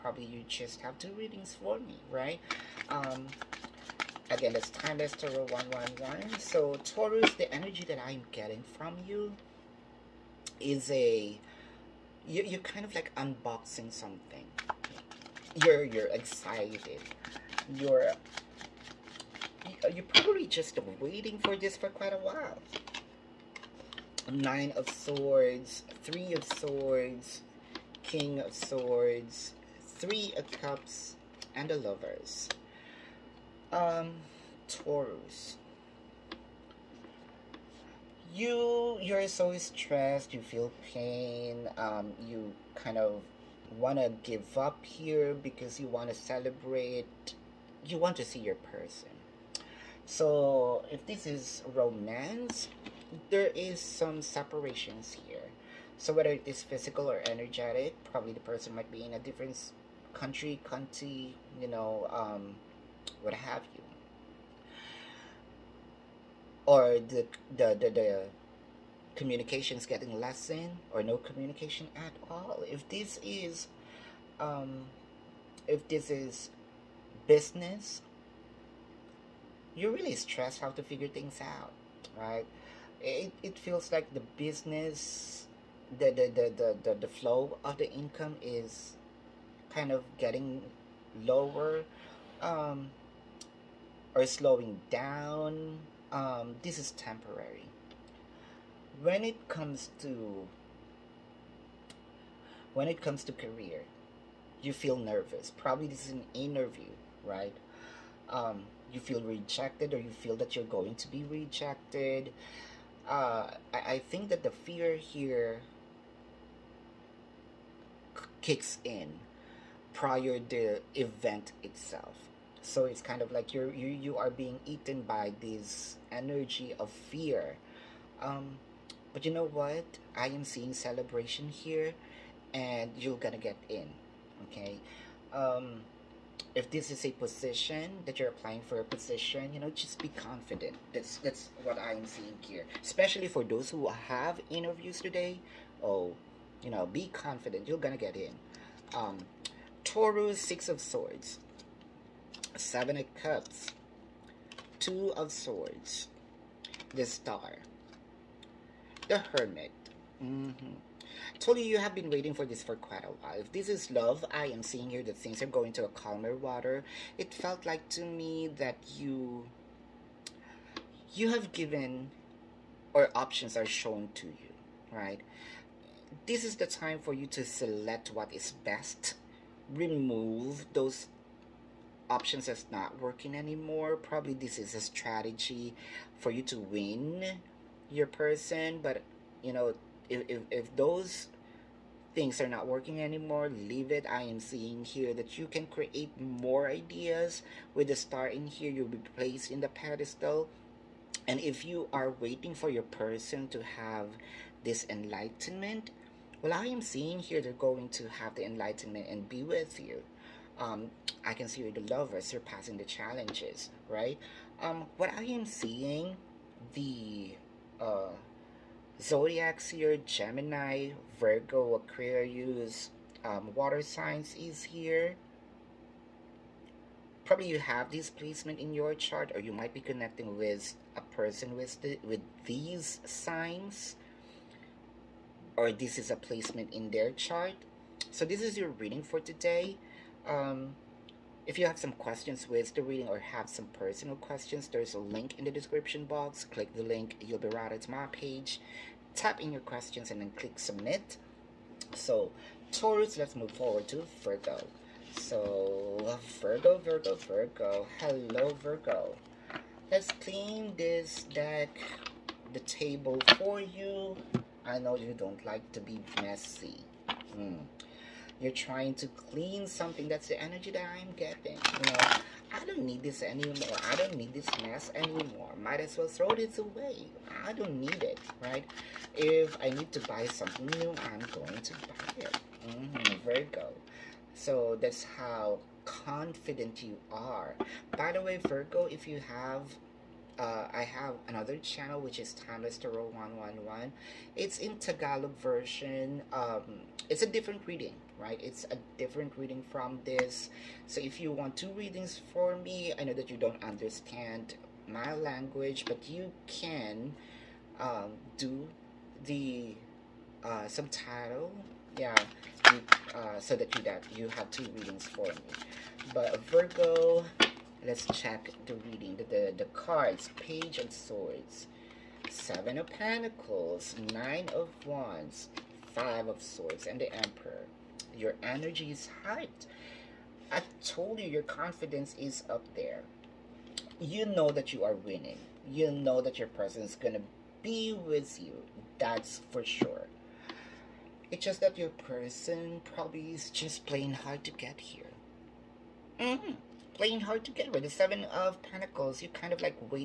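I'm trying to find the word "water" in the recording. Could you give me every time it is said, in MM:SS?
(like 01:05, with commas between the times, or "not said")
02:46, 03:43.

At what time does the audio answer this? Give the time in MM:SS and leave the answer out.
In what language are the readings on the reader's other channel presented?
04:54.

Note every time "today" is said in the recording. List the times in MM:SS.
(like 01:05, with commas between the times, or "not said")
02:25, 03:59.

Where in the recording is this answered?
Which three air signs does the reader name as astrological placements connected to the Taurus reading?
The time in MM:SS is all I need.
03:39.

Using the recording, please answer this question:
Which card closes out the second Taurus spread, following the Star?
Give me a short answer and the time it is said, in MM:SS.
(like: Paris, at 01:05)
The Hermit, at 02:39.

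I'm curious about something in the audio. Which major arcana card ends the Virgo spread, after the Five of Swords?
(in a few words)
The Emperor.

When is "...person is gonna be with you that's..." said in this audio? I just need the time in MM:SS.
05:36.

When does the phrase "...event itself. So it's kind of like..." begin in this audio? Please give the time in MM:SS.
02:00.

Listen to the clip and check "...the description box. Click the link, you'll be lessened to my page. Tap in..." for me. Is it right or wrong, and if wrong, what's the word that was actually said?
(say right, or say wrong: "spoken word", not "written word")
wrong: "routed", not "lessened".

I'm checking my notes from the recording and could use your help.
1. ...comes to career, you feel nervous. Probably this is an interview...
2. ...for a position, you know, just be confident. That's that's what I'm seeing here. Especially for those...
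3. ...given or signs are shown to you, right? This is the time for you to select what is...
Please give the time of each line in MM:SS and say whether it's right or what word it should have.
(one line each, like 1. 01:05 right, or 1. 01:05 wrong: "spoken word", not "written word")
1. 01:43 right
2. 02:18 right
3. 02:51 wrong: "options", not "signs".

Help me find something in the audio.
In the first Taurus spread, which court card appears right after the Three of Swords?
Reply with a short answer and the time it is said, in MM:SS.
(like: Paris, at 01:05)
King of Swords, at 00:28.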